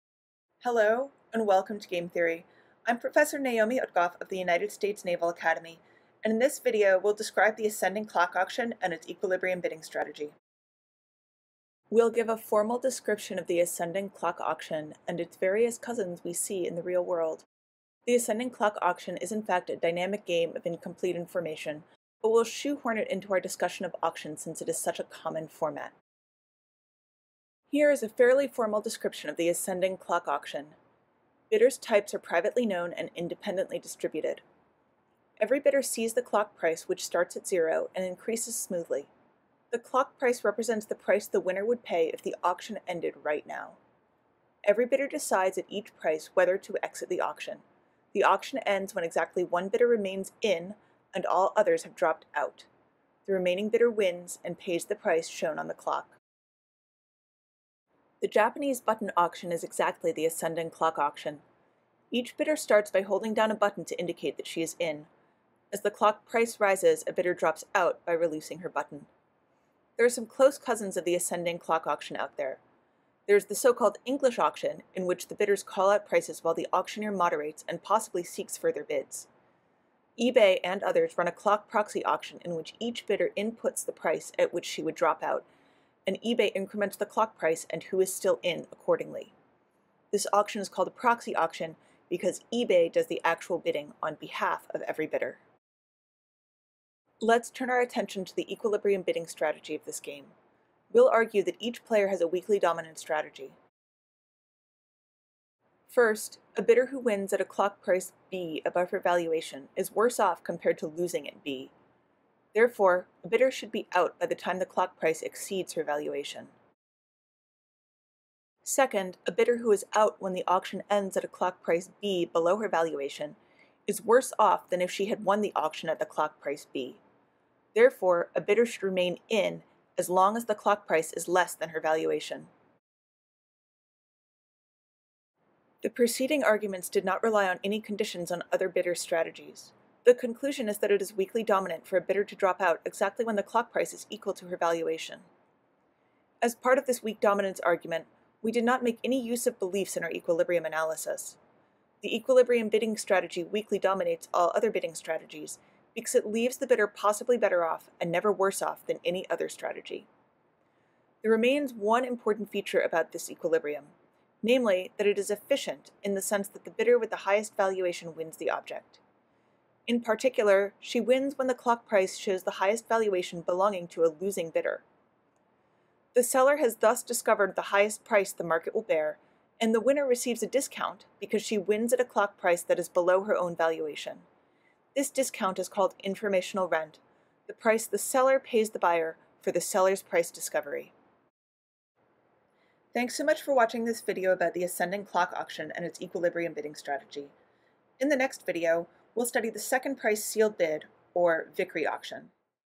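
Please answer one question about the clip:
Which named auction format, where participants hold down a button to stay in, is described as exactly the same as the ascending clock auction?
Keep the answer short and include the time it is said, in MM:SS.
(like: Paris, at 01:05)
Japanese button auction, at 00:58.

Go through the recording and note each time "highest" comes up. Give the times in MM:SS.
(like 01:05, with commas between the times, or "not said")
02:47, 02:52, 02:57.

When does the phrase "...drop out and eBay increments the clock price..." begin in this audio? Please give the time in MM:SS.
01:24.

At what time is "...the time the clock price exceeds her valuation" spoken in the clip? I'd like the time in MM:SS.
01:54.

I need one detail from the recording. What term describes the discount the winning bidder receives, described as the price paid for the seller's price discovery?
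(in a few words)
informational rent.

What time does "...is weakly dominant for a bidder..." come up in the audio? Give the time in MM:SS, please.
02:21.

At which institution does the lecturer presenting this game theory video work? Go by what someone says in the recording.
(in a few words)
United States Naval Academy.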